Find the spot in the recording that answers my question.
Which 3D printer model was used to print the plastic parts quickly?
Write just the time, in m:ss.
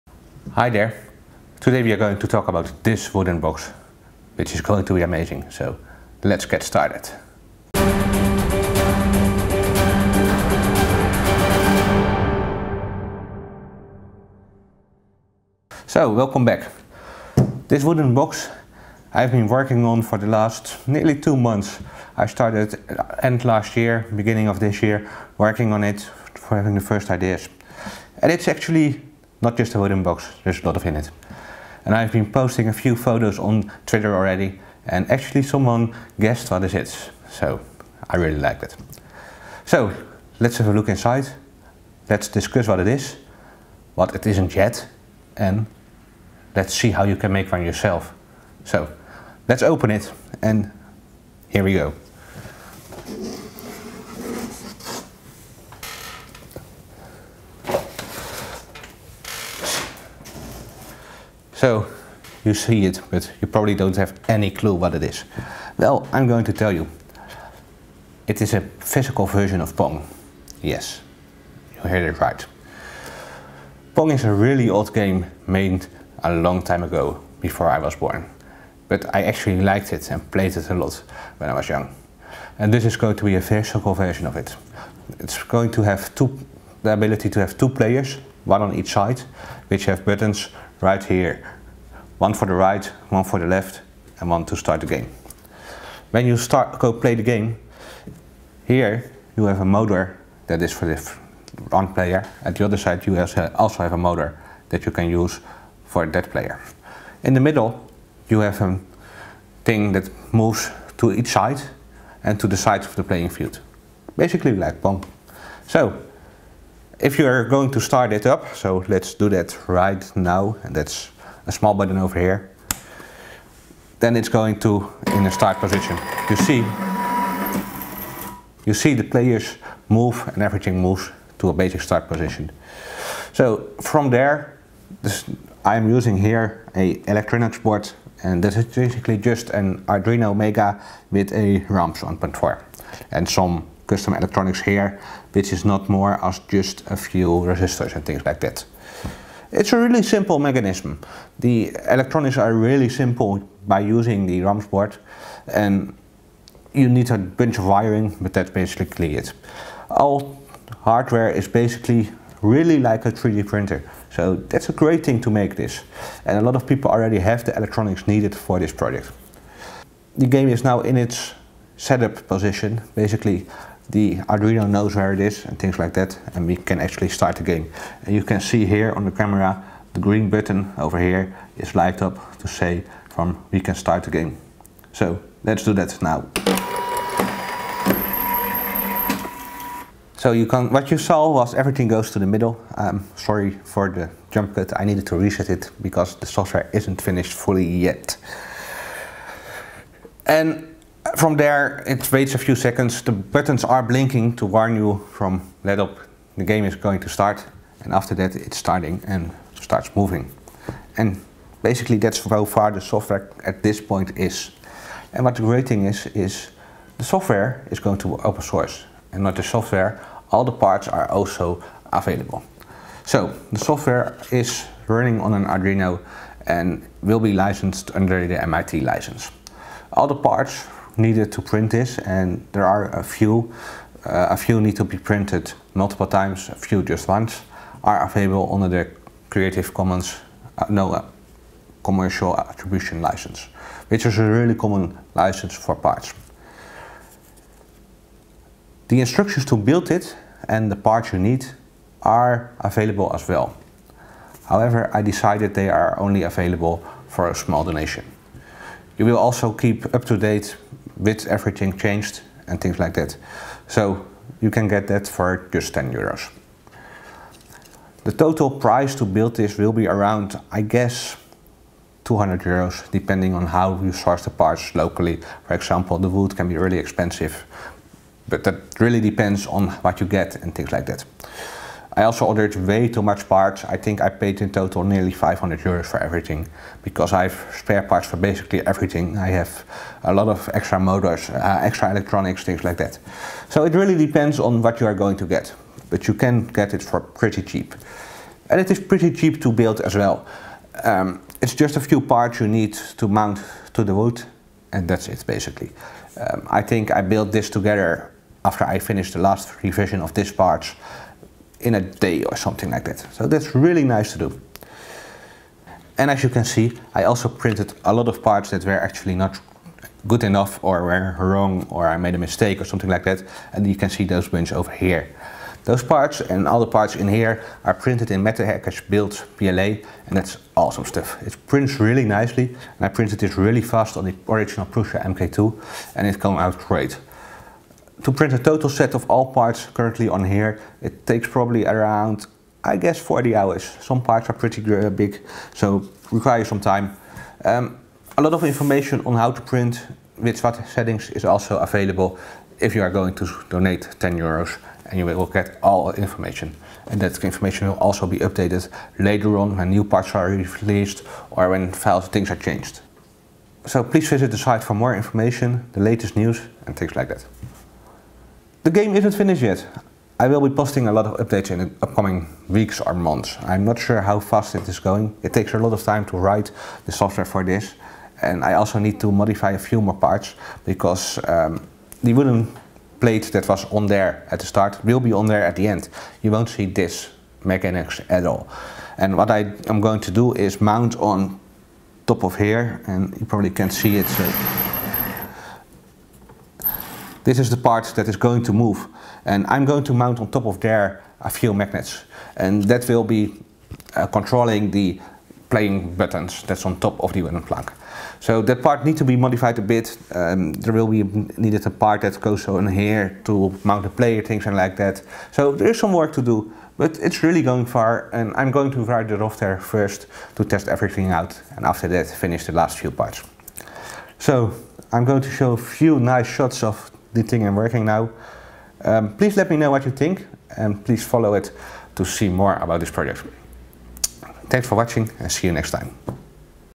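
5:34.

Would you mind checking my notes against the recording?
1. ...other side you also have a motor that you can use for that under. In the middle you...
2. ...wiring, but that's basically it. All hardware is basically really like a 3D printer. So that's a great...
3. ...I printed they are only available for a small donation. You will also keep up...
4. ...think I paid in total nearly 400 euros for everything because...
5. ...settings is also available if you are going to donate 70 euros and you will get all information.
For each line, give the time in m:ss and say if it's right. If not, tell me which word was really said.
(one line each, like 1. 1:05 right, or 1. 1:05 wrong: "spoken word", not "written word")
1. 1:42 wrong: "player", not "under"
2. 2:37 right
3. 4:14 wrong: "decided", not "printed"
4. 4:43 wrong: "500", not "400"
5. 5:50 wrong: "10", not "70".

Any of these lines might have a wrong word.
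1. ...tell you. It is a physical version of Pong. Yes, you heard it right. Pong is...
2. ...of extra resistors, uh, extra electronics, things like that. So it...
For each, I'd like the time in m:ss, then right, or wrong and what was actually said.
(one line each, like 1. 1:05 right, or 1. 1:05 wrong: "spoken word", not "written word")
1. 1:06 right
2. 4:50 wrong: "motors", not "resistors".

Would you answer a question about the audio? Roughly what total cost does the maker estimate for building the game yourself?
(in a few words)
200 euros.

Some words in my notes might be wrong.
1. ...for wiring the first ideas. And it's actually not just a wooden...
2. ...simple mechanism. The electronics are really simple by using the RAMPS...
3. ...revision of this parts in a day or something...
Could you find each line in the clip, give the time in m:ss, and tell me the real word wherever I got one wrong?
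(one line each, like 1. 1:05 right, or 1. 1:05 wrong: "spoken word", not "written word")
1. 0:26 wrong: "having", not "wiring"
2. 2:30 right
3. 5:09 right.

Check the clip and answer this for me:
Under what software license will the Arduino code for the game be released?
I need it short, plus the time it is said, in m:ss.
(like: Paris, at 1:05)
MIT license, at 3:48.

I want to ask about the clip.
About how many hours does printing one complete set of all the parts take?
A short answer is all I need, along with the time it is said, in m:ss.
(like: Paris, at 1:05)
40 hours, at 5:42.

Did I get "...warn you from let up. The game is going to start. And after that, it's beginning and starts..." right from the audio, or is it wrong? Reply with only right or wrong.
wrong.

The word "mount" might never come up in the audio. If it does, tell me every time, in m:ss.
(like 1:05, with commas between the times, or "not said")
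5:03, 6:30, 6:39, 6:53.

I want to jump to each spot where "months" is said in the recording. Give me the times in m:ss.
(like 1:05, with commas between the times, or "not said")
0:21, 6:12.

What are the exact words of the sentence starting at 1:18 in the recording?
But I actually liked it and played it a lot when I was young.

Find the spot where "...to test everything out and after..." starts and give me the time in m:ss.
7:00.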